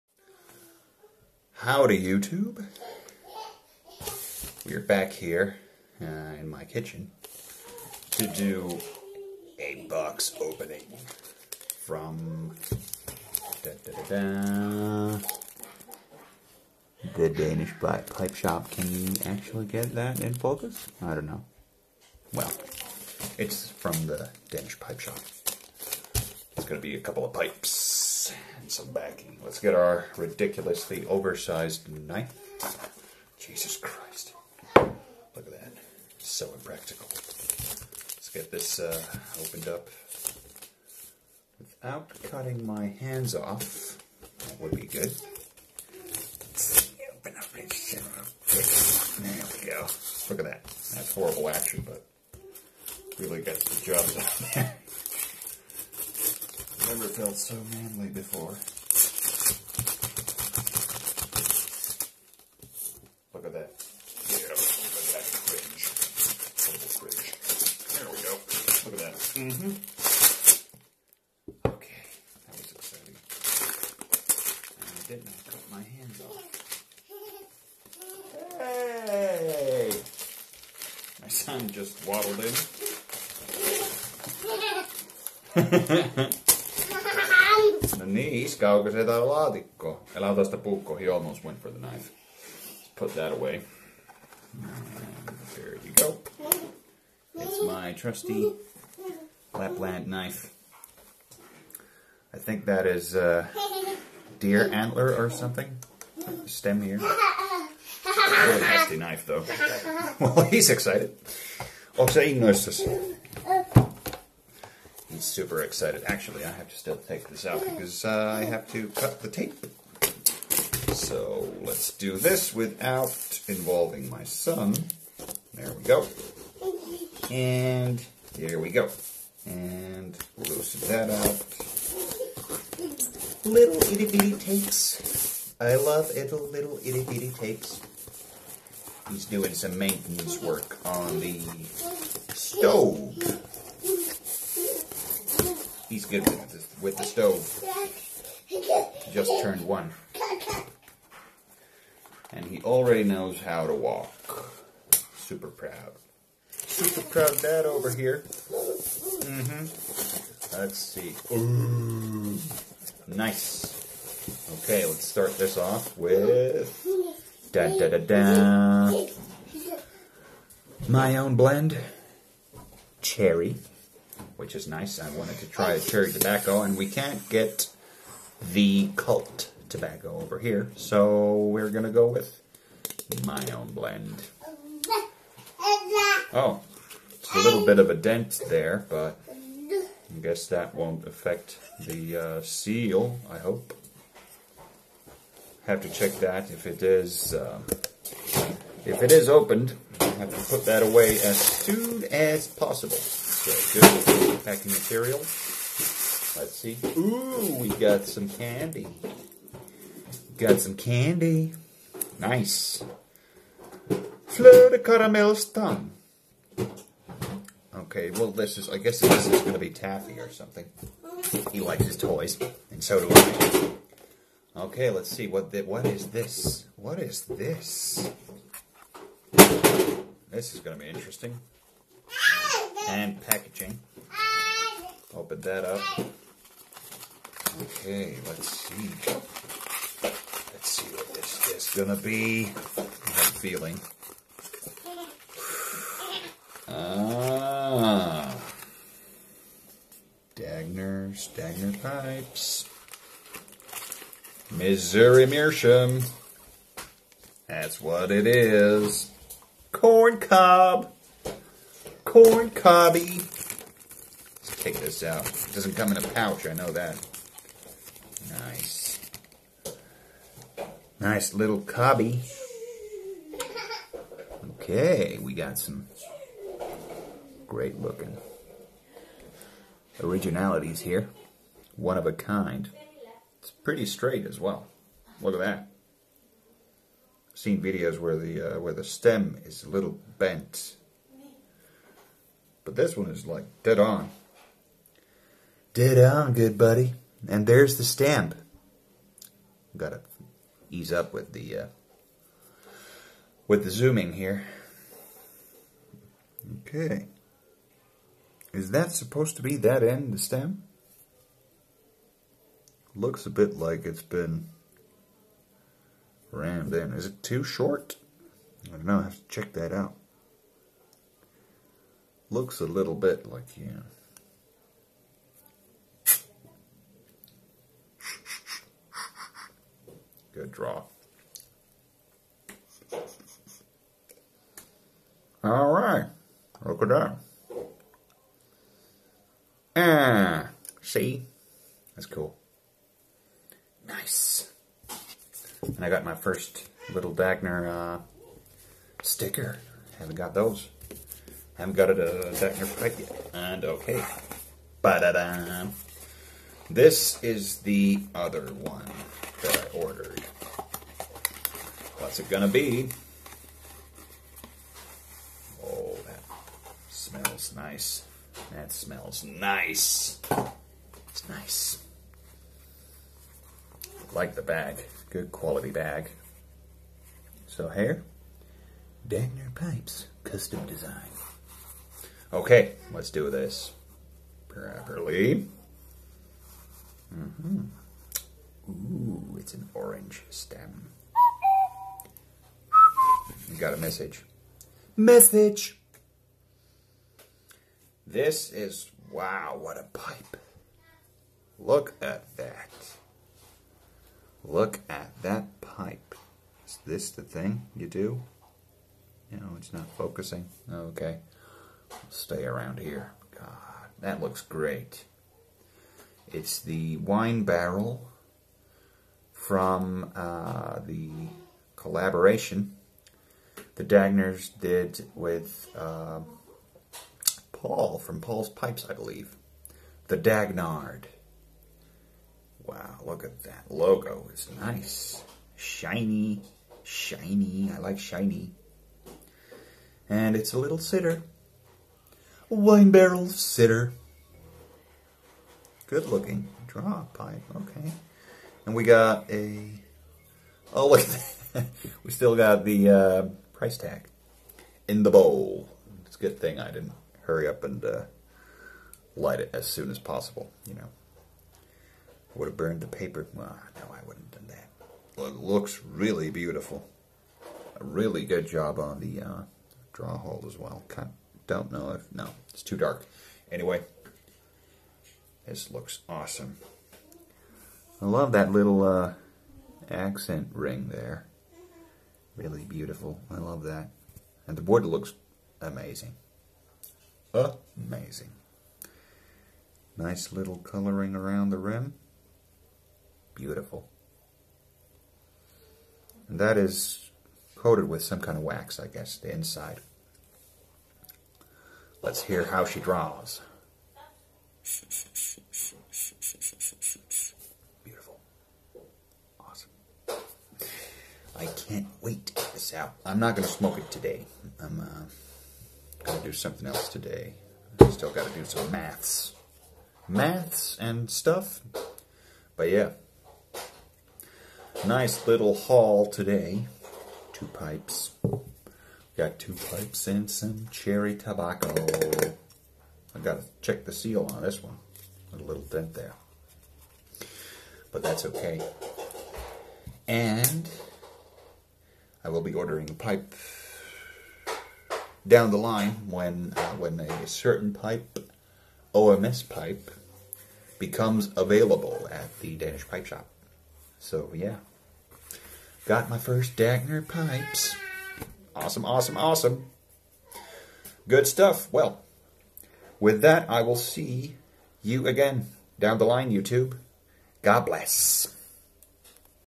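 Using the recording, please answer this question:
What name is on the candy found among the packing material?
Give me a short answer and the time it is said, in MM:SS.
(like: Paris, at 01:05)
Fleur de caramel stum, at 03:34.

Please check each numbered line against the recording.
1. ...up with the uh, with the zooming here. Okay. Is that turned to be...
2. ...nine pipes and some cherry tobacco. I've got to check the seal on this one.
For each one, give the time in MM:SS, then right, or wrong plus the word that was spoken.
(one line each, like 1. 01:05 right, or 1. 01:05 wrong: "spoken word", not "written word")
1. 05:00 wrong: "supposed", not "turned"
2. 08:49 wrong: "two", not "nine".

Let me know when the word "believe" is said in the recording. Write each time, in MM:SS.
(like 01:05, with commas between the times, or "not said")
07:08.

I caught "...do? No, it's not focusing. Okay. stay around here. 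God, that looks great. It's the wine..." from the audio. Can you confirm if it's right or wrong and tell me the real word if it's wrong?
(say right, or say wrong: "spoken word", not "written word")
right.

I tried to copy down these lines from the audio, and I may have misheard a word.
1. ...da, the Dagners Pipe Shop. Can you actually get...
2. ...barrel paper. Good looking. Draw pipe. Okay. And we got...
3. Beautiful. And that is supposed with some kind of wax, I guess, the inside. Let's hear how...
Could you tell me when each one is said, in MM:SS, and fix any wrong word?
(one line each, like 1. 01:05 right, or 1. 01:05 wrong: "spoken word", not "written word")
1. 00:15 wrong: "Danish", not "Dagners"
2. 07:22 wrong: "sitter", not "paper"
3. 08:13 wrong: "coated", not "supposed".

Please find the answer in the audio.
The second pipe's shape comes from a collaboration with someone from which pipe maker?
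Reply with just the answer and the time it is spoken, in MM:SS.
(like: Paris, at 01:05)
Paul's Pipes, at 07:08.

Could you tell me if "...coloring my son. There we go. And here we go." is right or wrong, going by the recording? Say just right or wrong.
wrong.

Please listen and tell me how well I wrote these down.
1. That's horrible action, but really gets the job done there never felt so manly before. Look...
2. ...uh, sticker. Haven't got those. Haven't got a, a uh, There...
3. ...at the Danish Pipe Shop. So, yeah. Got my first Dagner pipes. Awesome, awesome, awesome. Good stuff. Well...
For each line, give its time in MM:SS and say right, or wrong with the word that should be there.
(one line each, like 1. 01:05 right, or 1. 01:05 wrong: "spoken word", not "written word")
1. 00:50 right
2. 05:47 wrong: "Dagner", not "There"
3. 09:12 right.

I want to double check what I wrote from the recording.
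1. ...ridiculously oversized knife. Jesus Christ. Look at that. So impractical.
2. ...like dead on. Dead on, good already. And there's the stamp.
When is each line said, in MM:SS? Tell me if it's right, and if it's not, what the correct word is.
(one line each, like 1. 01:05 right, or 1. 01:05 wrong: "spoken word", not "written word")
1. 00:30 right
2. 04:53 wrong: "buddy", not "already".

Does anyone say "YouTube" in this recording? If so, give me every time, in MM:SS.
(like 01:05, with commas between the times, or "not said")
00:02, 09:26.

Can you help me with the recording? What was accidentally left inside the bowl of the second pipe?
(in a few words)
Price tag.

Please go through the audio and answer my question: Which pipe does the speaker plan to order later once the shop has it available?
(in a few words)
OMS pipe.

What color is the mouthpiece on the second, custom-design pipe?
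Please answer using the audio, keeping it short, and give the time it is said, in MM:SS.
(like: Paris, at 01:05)
Orange, at 06:29.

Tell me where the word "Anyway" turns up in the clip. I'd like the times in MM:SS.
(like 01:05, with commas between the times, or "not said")
07:53.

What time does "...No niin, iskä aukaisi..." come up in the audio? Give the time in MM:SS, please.
01:27.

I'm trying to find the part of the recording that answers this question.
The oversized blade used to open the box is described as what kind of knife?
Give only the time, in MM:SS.
01:39.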